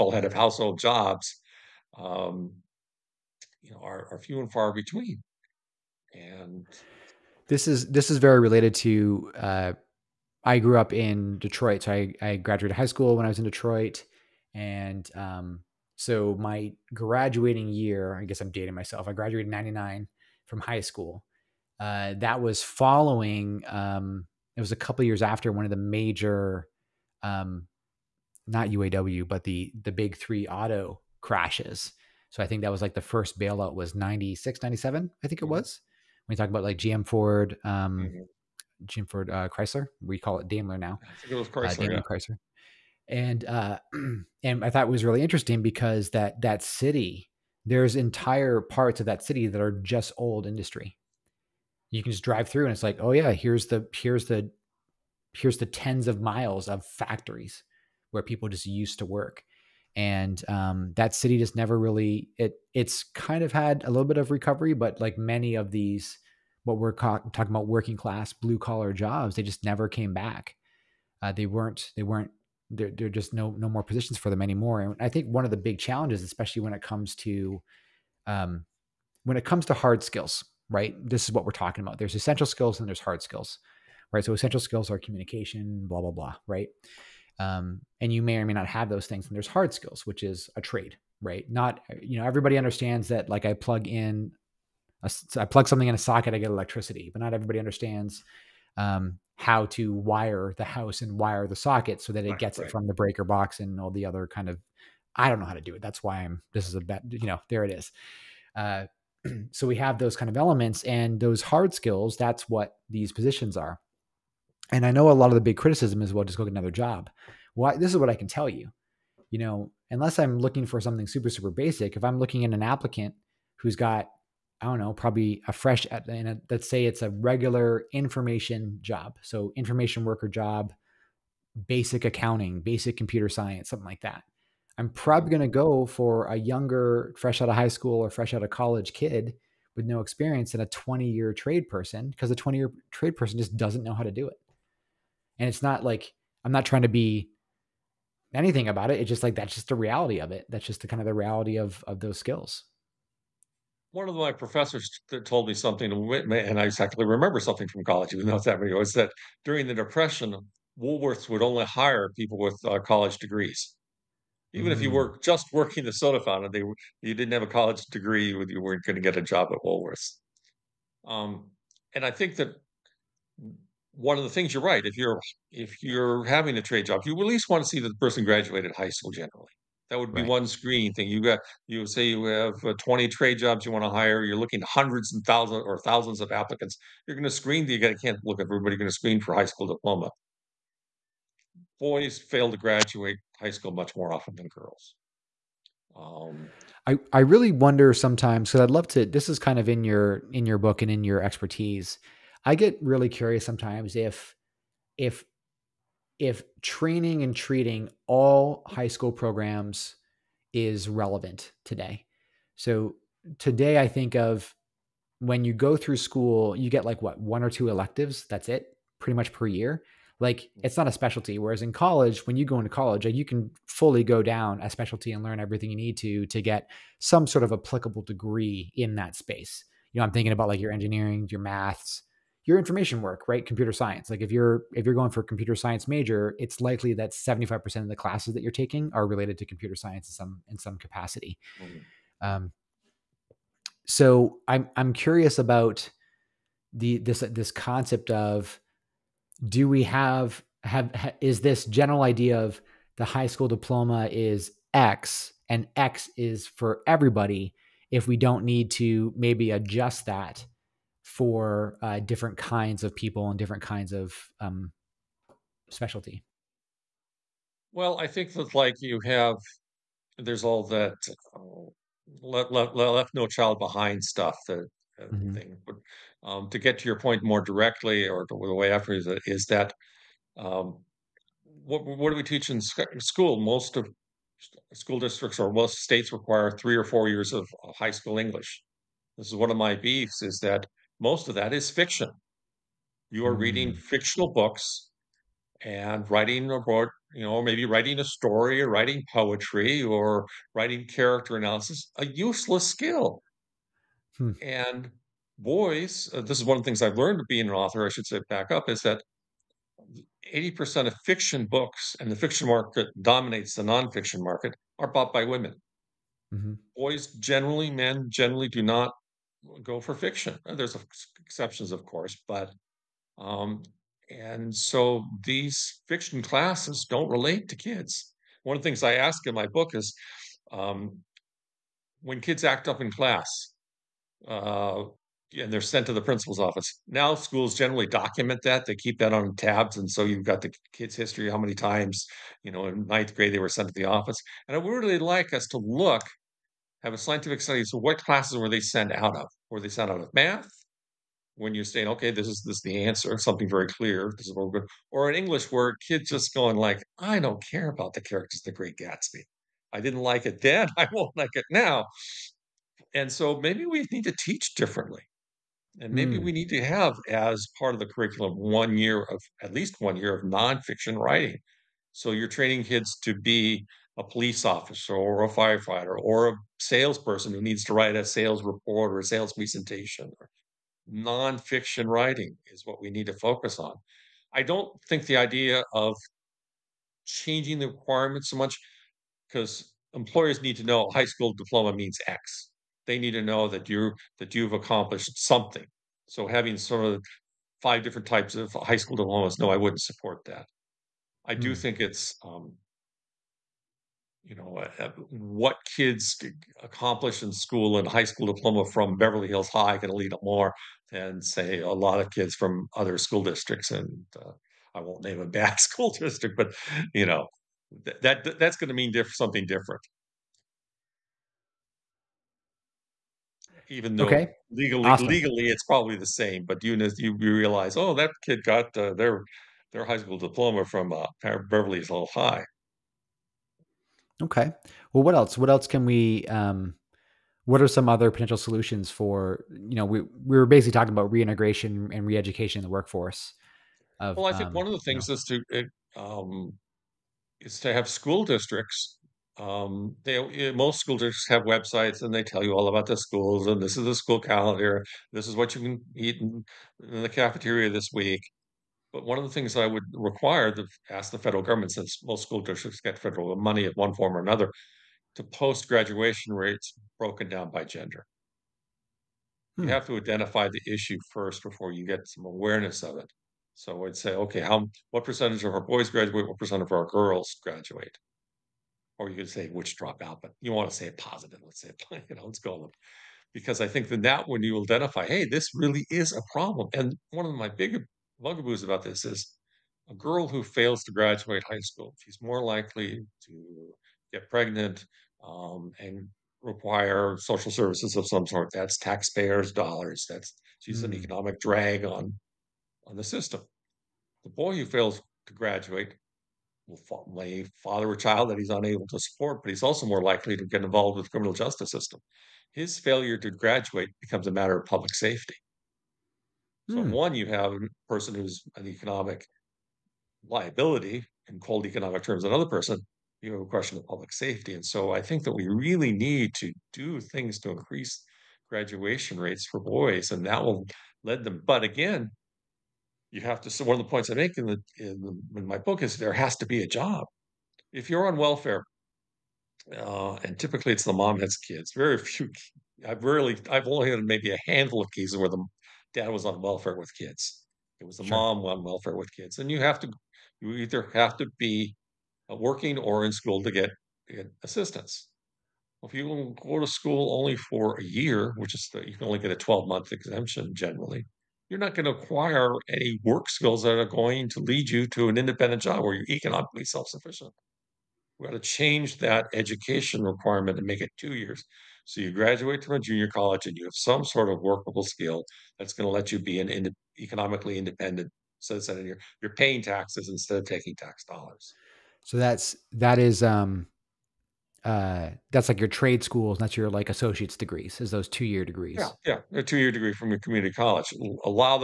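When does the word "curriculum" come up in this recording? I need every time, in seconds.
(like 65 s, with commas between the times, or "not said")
367 s.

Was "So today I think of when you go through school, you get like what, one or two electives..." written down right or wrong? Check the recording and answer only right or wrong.
right.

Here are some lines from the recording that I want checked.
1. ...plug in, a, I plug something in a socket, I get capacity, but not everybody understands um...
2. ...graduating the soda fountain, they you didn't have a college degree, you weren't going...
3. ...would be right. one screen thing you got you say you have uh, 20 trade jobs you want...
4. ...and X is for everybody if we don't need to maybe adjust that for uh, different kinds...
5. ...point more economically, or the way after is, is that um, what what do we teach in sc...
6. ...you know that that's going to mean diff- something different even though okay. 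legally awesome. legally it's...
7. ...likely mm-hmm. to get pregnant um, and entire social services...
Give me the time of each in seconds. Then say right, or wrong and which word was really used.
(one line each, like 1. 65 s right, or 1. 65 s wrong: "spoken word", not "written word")
1. 93 s wrong: "electricity", not "capacity"
2. 165 s wrong: "working", not "graduating"
3. 179 s right
4. 255 s right
5. 276 s wrong: "directly", not "economically"
6. 416 s right
7. 492 s wrong: "require", not "entire".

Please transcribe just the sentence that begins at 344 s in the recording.
And I would really like us to look have a scientific study.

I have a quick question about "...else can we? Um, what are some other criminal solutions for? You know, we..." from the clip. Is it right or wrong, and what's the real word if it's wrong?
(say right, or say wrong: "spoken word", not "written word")
wrong: "potential", not "criminal".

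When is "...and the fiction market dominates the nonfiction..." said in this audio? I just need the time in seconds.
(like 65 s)
311 s.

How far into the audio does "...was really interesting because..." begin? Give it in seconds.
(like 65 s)
44 s.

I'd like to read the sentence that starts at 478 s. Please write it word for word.
Or you could say which drop out, but you want to say it positive.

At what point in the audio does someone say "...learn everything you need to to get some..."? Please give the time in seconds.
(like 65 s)
225 s.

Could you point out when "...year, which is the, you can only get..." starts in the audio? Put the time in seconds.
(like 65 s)
557 s.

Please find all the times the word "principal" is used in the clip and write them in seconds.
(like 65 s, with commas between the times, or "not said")
336 s.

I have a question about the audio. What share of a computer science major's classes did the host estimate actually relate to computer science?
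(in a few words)
75%.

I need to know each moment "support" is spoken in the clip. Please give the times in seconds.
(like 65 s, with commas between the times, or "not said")
399 s, 508 s.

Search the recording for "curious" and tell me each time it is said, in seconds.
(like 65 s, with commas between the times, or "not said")
203 s, 244 s.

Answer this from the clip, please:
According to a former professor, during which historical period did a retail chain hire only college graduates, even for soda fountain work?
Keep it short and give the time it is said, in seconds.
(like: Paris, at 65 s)
The Depression, at 159 s.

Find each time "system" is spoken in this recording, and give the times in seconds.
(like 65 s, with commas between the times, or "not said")
503 s, 511 s.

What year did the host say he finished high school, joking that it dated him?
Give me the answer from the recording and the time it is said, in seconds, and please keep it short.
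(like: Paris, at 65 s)
1999, at 19 s.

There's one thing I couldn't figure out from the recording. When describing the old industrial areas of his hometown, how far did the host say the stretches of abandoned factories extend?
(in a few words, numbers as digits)
Tens of miles.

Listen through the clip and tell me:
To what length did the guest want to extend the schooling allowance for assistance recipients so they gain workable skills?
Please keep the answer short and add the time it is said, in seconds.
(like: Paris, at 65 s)
Two years, at 570 s.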